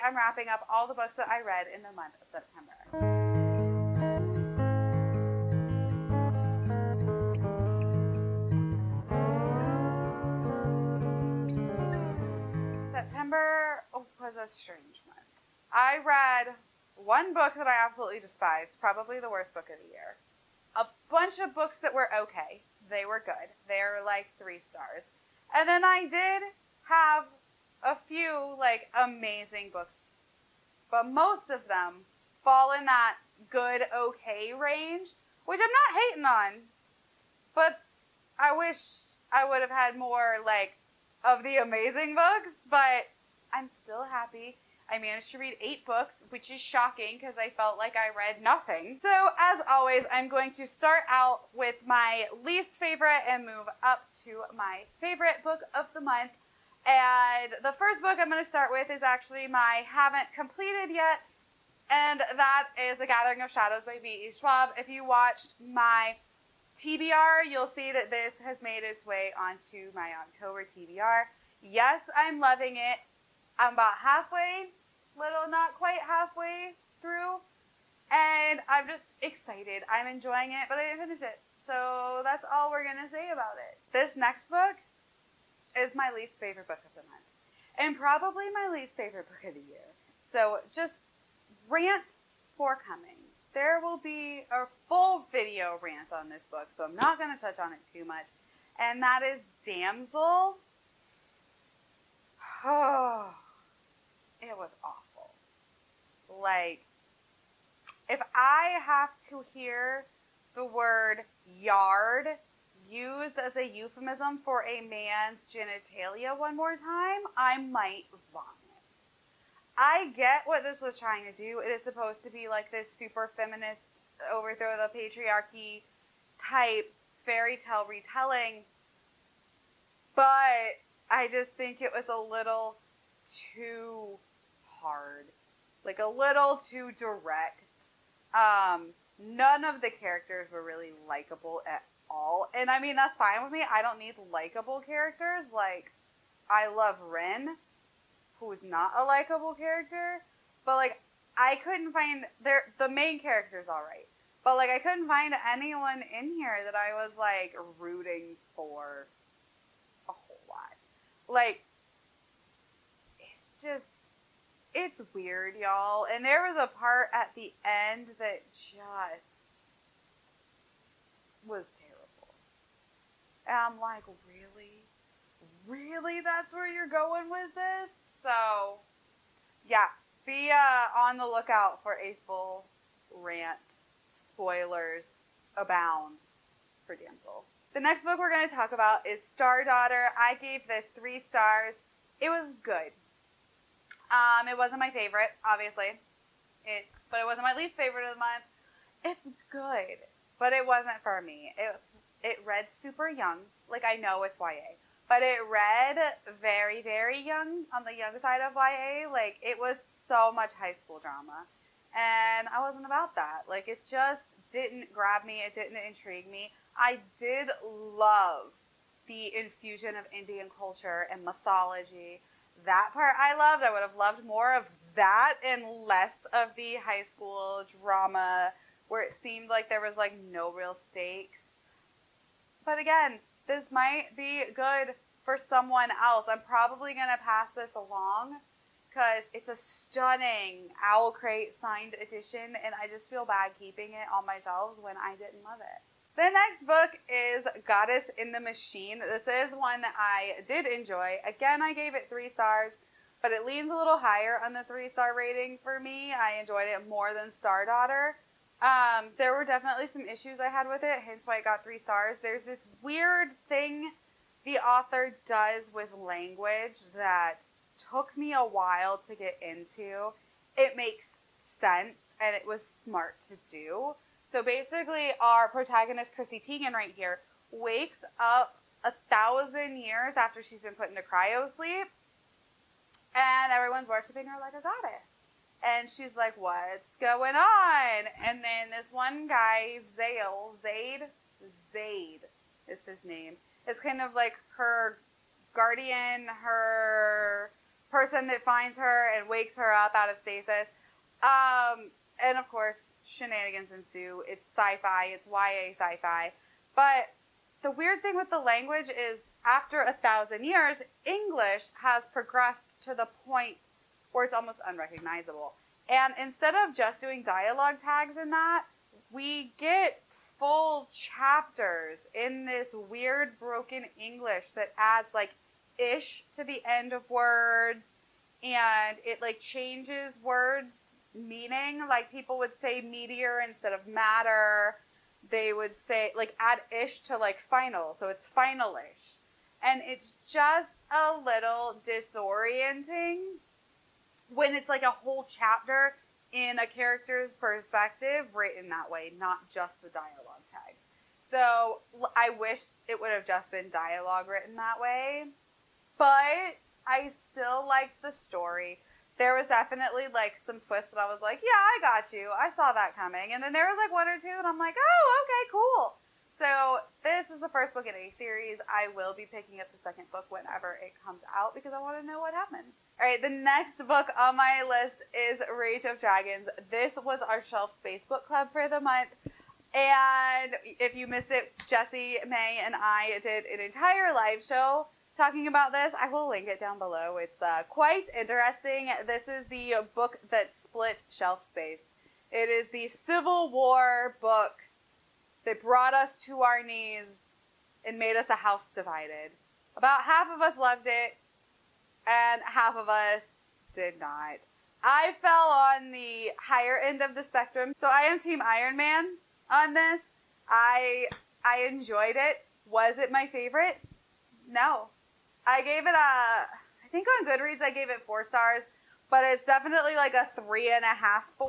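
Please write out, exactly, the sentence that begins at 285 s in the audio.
And she's like, What's going on?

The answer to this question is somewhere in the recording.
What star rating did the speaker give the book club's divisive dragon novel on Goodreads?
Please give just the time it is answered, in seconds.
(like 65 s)
418 s.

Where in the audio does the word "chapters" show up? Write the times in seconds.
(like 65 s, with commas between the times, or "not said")
320 s, 345 s.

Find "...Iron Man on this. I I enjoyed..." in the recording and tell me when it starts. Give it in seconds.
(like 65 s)
408 s.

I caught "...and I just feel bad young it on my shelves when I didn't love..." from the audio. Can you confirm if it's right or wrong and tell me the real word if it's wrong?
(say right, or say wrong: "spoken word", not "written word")
wrong: "keeping", not "young".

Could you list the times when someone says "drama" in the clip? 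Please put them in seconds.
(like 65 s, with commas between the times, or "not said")
210 s, 227 s.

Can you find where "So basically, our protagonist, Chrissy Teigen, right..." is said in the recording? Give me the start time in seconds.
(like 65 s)
274 s.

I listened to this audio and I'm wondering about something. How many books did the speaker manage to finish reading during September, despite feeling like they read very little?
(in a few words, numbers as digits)
8.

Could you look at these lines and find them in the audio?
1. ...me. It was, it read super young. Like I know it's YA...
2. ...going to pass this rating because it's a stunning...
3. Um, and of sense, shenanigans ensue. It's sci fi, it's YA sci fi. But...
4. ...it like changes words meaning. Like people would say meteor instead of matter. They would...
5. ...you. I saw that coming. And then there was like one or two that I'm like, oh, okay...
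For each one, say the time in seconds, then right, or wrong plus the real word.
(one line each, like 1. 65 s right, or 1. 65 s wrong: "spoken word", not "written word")
1. 201 s right
2. 236 s wrong: "along", not "rating"
3. 301 s wrong: "course", not "sense"
4. 329 s right
5. 362 s right.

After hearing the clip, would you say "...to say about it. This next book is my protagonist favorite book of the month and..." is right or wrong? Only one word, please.
wrong.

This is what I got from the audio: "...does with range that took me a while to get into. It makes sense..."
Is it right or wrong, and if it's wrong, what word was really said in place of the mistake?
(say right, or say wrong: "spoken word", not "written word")
wrong: "language", not "range".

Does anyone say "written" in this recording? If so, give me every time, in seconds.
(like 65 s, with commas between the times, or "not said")
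348 s, 354 s.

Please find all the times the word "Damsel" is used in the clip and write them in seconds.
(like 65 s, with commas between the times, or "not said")
99 s, 186 s.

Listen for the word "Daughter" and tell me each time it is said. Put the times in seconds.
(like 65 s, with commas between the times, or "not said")
189 s, 257 s.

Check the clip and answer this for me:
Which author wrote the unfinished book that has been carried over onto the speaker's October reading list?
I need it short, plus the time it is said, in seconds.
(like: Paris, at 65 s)
V.E. Schwab, at 64 s.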